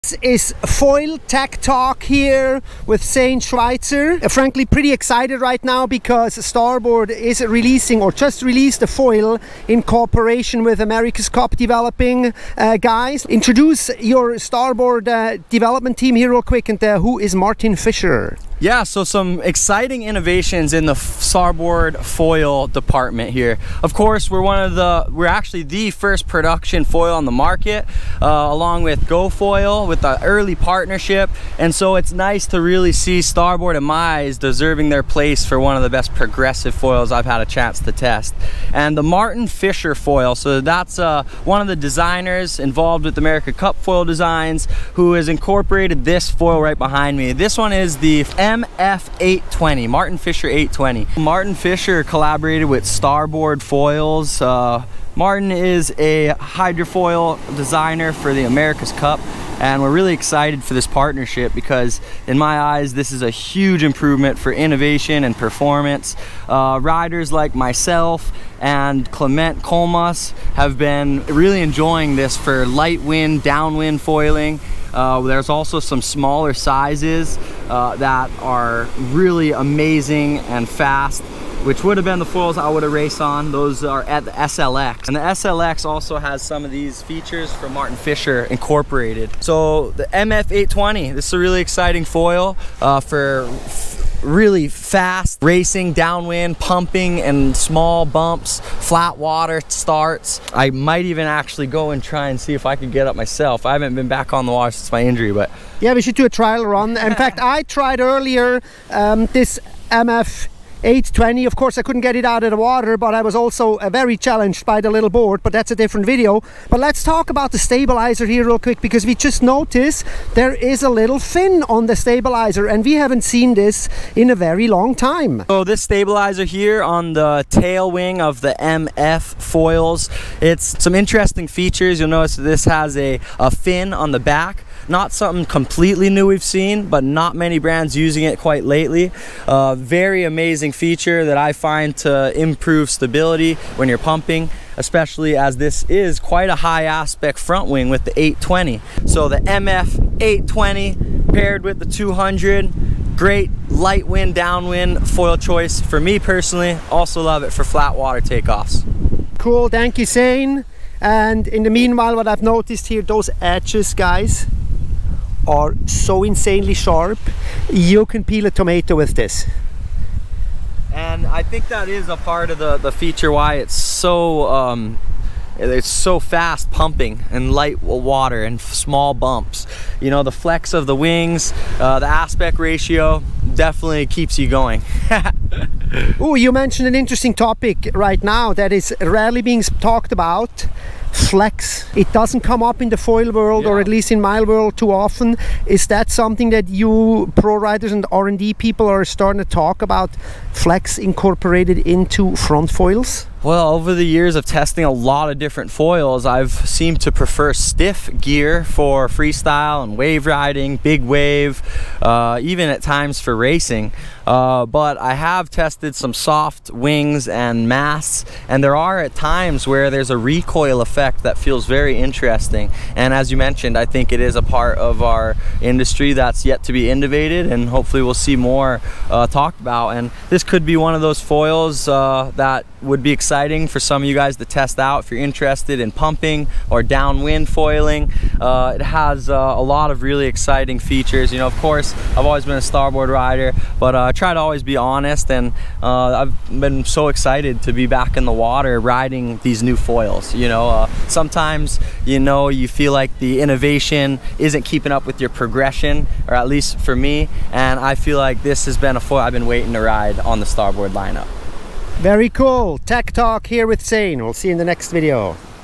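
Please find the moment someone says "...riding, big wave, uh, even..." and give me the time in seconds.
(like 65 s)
210 s.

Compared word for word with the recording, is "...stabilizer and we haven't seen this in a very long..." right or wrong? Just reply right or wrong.
right.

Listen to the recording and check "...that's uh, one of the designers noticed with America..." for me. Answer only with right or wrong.
wrong.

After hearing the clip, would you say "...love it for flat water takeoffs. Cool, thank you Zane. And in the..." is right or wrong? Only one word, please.
right.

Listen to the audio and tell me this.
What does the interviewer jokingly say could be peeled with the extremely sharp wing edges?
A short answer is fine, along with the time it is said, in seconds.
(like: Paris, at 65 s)
Tomato, at 168 s.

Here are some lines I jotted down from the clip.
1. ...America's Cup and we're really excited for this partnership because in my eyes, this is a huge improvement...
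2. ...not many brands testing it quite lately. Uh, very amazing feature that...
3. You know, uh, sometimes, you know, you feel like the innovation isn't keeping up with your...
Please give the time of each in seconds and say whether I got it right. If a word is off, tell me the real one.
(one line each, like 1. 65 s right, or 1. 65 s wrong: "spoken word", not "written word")
1. 58 s right
2. 137 s wrong: "using", not "testing"
3. 250 s right.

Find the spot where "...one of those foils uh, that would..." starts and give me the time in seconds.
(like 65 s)
230 s.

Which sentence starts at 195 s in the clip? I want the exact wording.
Is that something that you pro riders and R&D people are starting to talk about flex incorporated into front foils?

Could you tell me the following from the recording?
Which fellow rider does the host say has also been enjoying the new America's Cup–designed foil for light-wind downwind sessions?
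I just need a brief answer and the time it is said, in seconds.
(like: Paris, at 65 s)
Clement Colmas, at 69 s.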